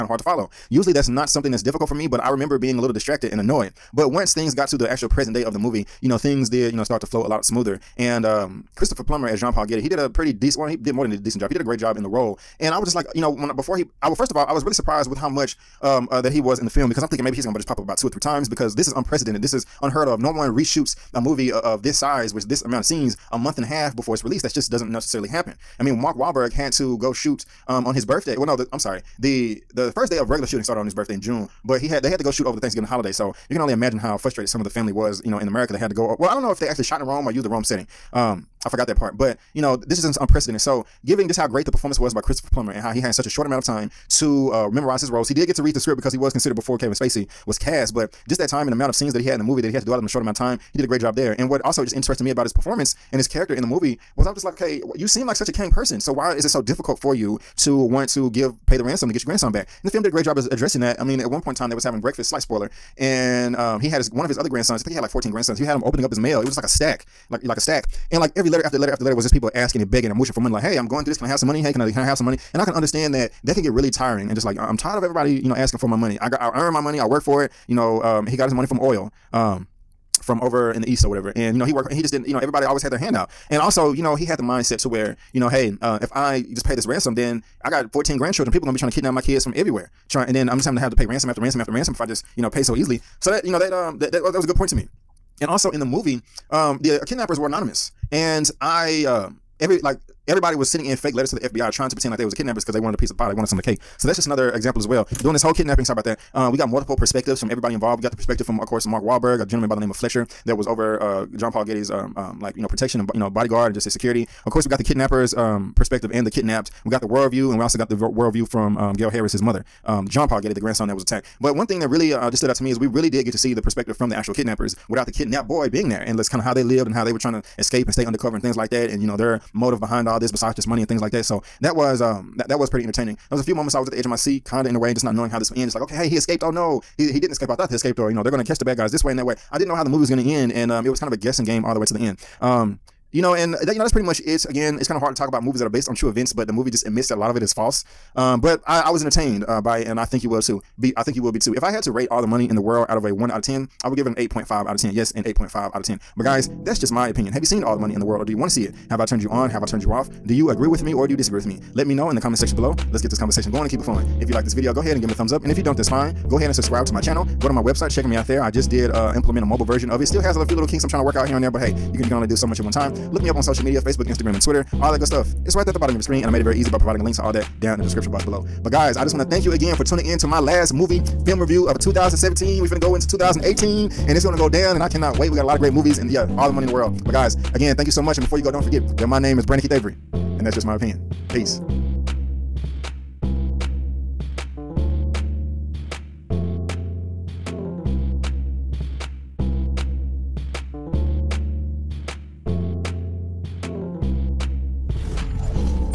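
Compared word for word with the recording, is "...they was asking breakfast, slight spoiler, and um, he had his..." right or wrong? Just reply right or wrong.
wrong.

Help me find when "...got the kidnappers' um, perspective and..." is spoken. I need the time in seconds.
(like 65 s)
114 s.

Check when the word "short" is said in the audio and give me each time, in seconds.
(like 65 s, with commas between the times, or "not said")
43 s, 50 s.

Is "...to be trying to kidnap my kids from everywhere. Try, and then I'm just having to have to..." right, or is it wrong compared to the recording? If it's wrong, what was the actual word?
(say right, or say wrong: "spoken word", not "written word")
right.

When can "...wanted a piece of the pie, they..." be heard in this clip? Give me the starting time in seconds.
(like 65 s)
102 s.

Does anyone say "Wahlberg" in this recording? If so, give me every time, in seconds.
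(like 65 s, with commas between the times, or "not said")
26 s, 109 s.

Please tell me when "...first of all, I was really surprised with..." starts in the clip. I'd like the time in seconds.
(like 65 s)
14 s.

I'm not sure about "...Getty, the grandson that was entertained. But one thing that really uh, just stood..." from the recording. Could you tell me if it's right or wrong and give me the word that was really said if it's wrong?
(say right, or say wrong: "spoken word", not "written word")
wrong: "attacked", not "entertained".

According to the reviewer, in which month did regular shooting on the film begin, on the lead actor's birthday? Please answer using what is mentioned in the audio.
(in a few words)
June.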